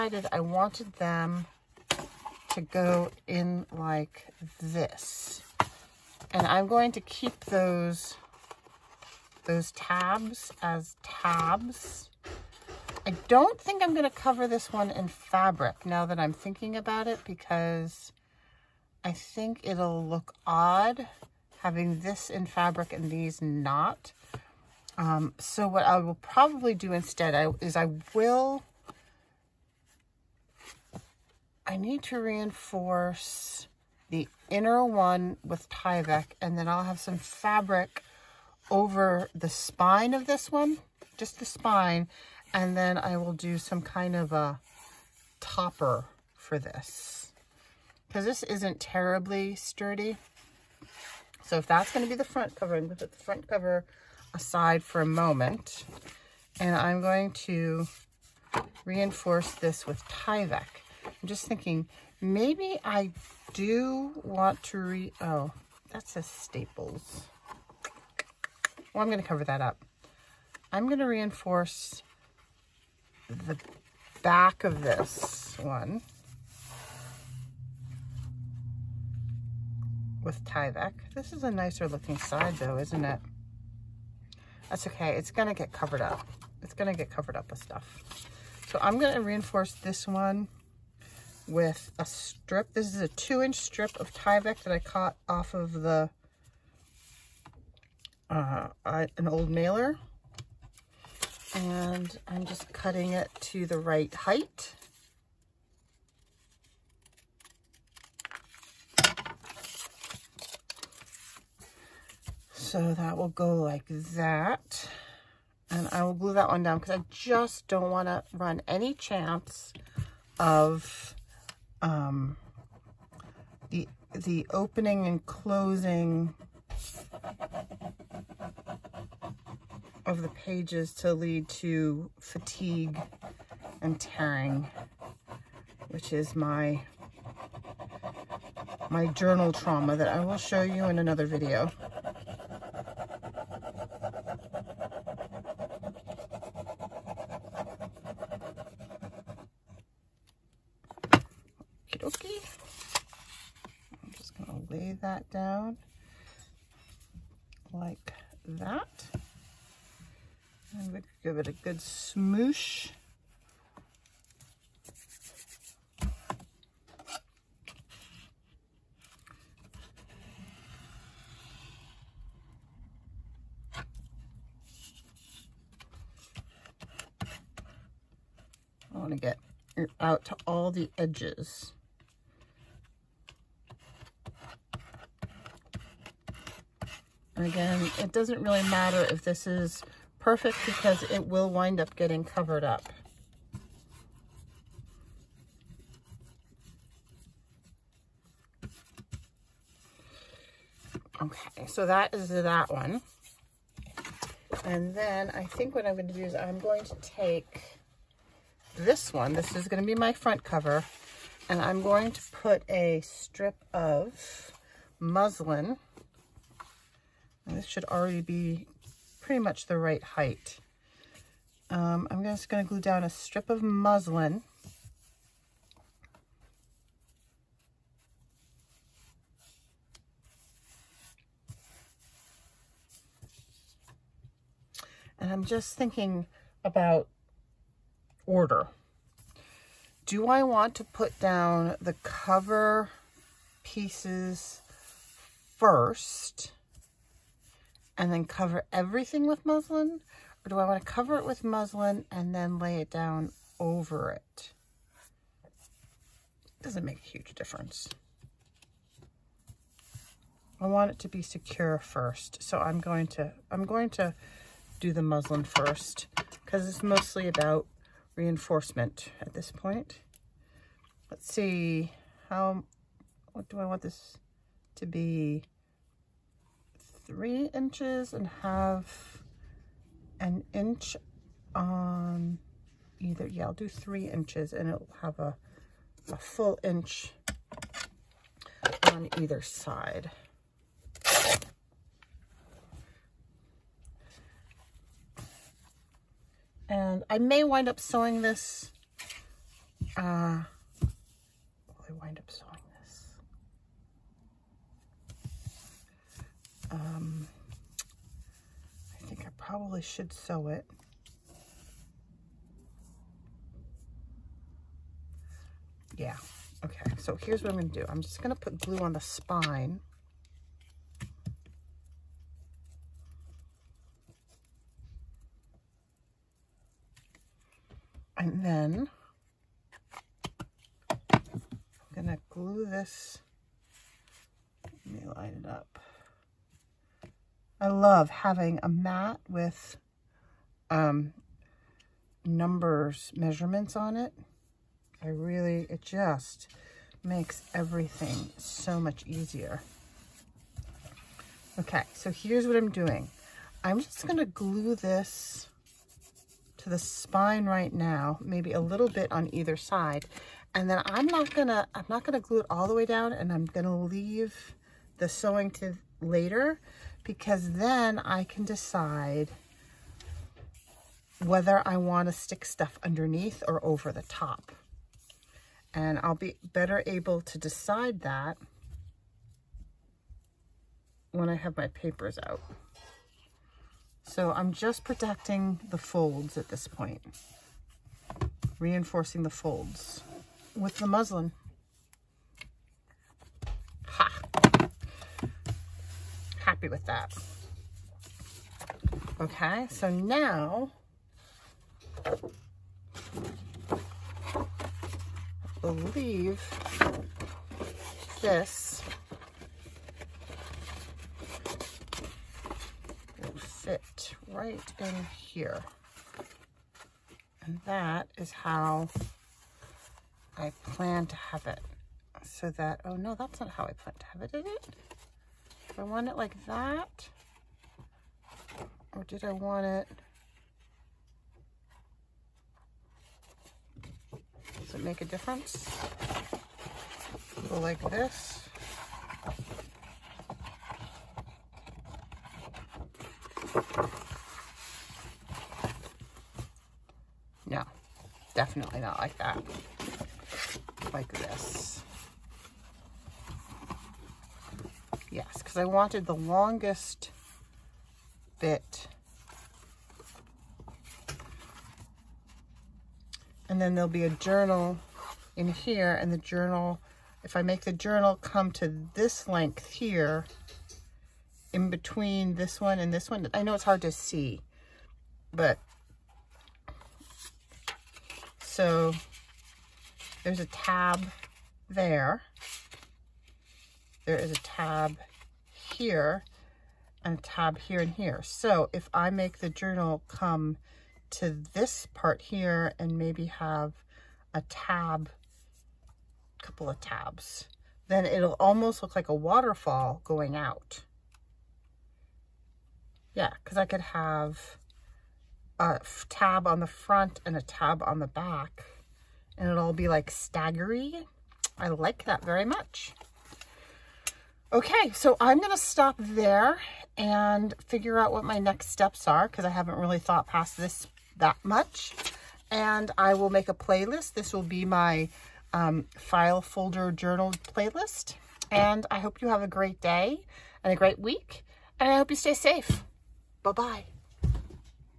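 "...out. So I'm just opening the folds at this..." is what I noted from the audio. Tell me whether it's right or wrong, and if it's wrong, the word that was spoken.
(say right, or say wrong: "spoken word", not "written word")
wrong: "protecting", not "opening".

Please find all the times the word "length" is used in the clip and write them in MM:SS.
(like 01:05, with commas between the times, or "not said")
07:49.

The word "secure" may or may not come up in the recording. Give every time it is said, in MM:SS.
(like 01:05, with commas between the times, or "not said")
04:21.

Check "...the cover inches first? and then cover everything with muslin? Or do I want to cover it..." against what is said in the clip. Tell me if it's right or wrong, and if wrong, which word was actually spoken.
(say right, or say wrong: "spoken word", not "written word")
wrong: "pieces", not "inches".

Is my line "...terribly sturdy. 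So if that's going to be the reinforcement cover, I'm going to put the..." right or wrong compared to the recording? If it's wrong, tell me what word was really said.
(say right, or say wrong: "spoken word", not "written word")
wrong: "front", not "reinforcement".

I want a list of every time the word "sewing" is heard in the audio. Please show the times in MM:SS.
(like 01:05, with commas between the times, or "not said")
04:57, 05:02, 06:05.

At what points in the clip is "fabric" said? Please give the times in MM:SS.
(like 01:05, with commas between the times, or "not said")
00:15, 00:22, 00:37.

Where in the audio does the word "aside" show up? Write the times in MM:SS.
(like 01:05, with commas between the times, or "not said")
00:54.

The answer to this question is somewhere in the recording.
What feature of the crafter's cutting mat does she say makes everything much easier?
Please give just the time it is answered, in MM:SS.
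05:43.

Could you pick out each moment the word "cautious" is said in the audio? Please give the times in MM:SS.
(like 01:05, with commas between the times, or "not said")
not said.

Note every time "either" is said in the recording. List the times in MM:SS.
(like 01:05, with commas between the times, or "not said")
04:42, 04:49, 05:59.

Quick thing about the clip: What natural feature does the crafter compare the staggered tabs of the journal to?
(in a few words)
a waterfall.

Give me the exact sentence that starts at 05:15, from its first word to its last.
Yeah, okay, so here's what I'm gonna do.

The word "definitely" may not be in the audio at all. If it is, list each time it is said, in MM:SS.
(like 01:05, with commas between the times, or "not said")
07:28.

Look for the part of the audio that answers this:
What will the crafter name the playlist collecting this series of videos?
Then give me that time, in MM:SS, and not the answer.
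08:45.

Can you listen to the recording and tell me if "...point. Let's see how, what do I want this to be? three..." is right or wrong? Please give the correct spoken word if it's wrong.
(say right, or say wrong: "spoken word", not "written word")
right.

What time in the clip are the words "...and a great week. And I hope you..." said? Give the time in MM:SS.
08:50.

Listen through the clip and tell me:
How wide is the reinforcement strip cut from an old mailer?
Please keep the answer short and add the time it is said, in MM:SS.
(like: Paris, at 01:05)
2 inches, at 01:33.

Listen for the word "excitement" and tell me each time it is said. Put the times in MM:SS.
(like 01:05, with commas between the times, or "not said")
not said.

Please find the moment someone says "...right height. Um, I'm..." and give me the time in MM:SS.
03:39.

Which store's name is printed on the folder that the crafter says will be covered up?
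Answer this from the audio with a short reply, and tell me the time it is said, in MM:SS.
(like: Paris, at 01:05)
Staples, at 01:06.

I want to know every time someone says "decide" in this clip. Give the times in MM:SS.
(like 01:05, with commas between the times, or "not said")
06:08, 06:17.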